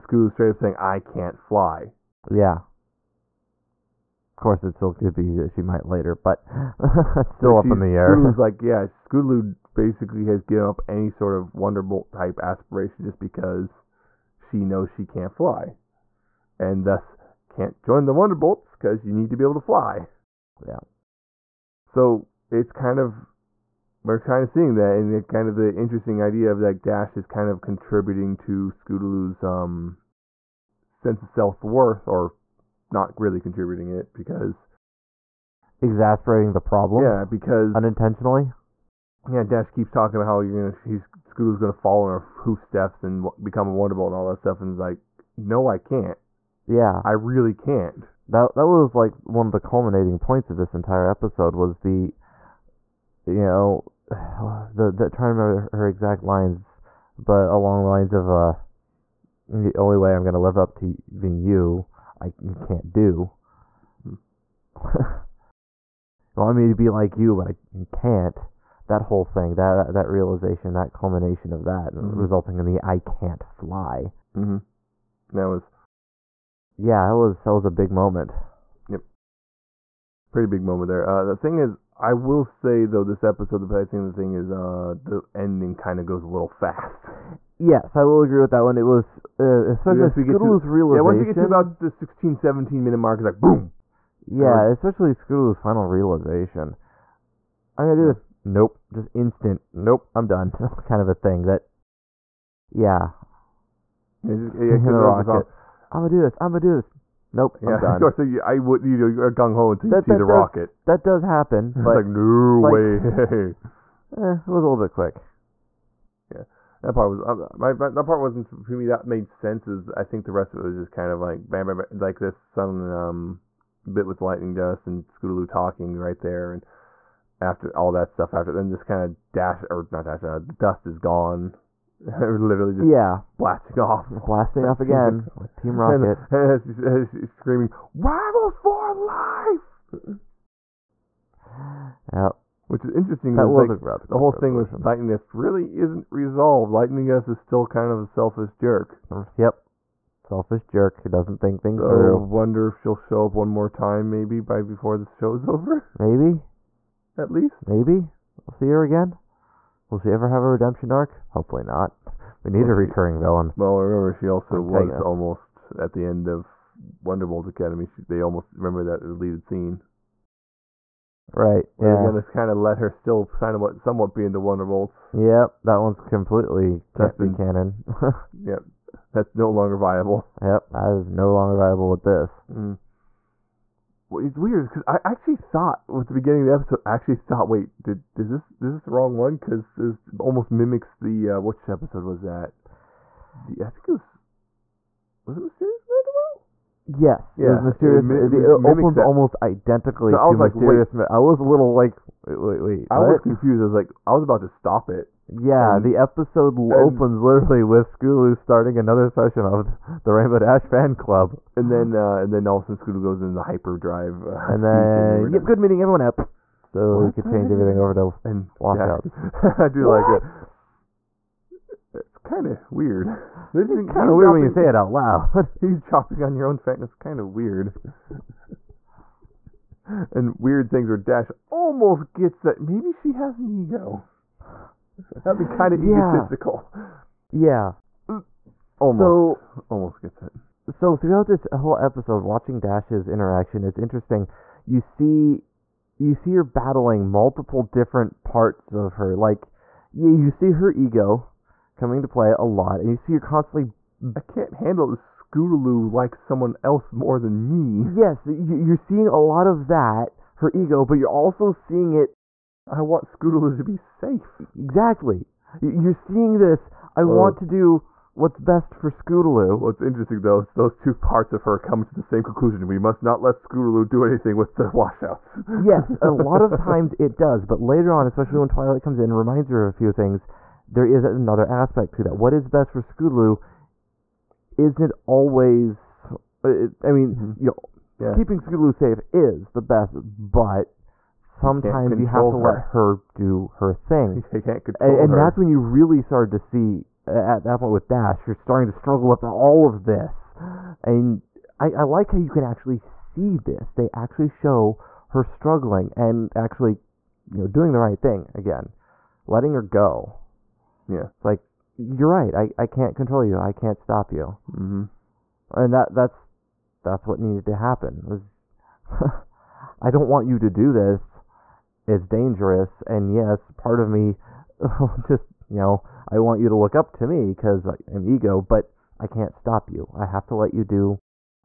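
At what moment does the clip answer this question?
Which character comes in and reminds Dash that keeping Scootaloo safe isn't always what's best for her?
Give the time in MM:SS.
04:38.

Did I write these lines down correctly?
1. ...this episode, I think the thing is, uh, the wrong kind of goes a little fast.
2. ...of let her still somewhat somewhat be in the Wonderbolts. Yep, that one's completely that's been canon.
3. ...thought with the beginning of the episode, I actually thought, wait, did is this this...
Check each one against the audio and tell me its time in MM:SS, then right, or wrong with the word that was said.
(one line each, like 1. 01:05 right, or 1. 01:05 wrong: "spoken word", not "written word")
1. 01:23 wrong: "ending", not "wrong"
2. 02:52 right
3. 03:05 right.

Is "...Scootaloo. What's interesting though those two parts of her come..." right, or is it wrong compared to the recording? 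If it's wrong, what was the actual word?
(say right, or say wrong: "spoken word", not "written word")
right.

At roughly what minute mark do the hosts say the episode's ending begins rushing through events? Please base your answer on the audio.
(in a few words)
16, 17 minute mark.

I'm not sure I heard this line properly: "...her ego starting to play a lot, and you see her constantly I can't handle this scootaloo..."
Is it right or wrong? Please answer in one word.
wrong.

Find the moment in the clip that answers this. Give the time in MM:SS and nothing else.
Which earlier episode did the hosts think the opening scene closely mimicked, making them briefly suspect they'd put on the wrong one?
03:15.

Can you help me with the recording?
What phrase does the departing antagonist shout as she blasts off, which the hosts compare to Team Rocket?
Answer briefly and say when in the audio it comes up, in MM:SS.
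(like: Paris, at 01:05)
Rivals for life, at 02:17.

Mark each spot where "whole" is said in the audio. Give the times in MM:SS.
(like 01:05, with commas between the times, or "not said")
01:09, 02:24, 04:01.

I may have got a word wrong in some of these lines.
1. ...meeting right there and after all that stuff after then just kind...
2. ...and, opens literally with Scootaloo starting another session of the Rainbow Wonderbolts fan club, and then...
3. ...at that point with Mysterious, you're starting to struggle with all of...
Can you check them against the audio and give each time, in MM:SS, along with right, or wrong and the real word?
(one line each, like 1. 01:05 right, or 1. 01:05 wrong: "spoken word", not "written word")
1. 02:05 wrong: "talking", not "meeting"
2. 03:26 wrong: "Dash", not "Wonderbolts"
3. 04:57 wrong: "Dash", not "Mysterious".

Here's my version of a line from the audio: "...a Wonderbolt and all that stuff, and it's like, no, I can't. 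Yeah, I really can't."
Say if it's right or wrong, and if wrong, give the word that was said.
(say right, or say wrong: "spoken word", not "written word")
right.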